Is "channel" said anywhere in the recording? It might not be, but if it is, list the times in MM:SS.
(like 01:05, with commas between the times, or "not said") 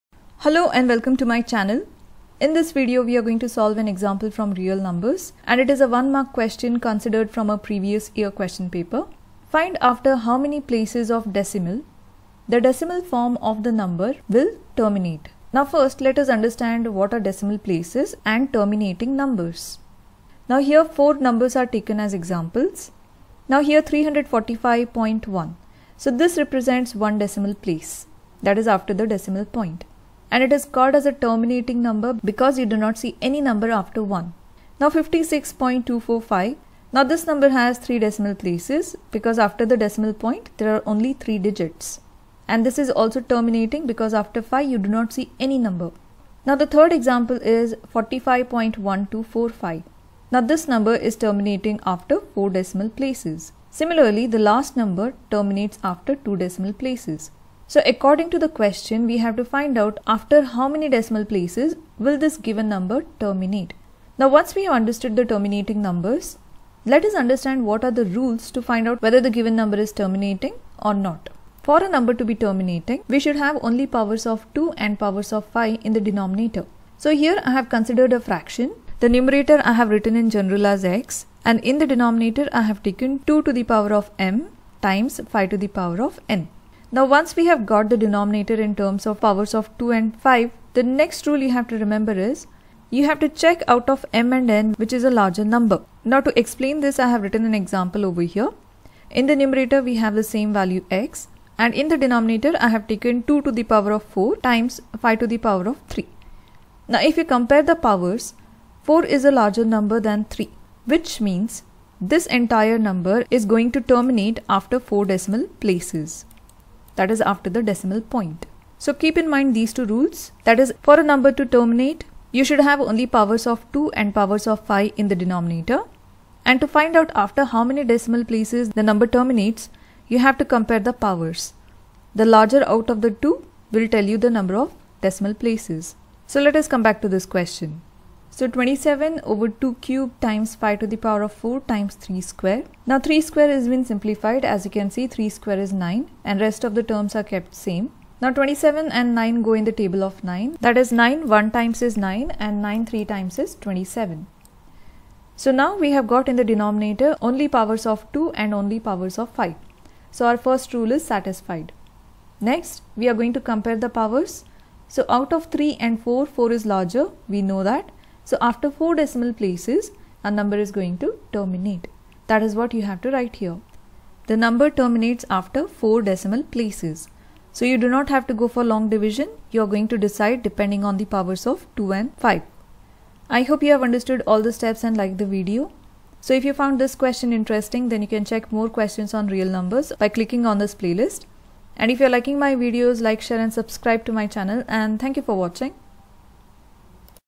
00:01, 03:14.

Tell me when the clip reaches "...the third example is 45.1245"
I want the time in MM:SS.
00:46.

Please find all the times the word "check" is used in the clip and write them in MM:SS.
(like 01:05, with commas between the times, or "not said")
01:33, 03:08.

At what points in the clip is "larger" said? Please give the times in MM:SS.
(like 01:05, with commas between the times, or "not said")
01:35, 01:49, 02:12, 02:46.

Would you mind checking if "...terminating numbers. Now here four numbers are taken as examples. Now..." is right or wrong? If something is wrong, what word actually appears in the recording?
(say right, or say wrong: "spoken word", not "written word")
right.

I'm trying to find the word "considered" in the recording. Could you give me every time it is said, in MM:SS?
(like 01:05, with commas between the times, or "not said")
00:06, 01:17.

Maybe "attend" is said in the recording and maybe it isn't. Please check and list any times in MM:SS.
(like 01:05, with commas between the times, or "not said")
not said.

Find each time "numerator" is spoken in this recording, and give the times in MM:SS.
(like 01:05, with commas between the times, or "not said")
01:19, 01:39.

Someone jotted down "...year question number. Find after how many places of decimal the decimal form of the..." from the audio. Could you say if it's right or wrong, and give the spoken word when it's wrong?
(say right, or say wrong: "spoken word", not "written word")
wrong: "paper", not "number".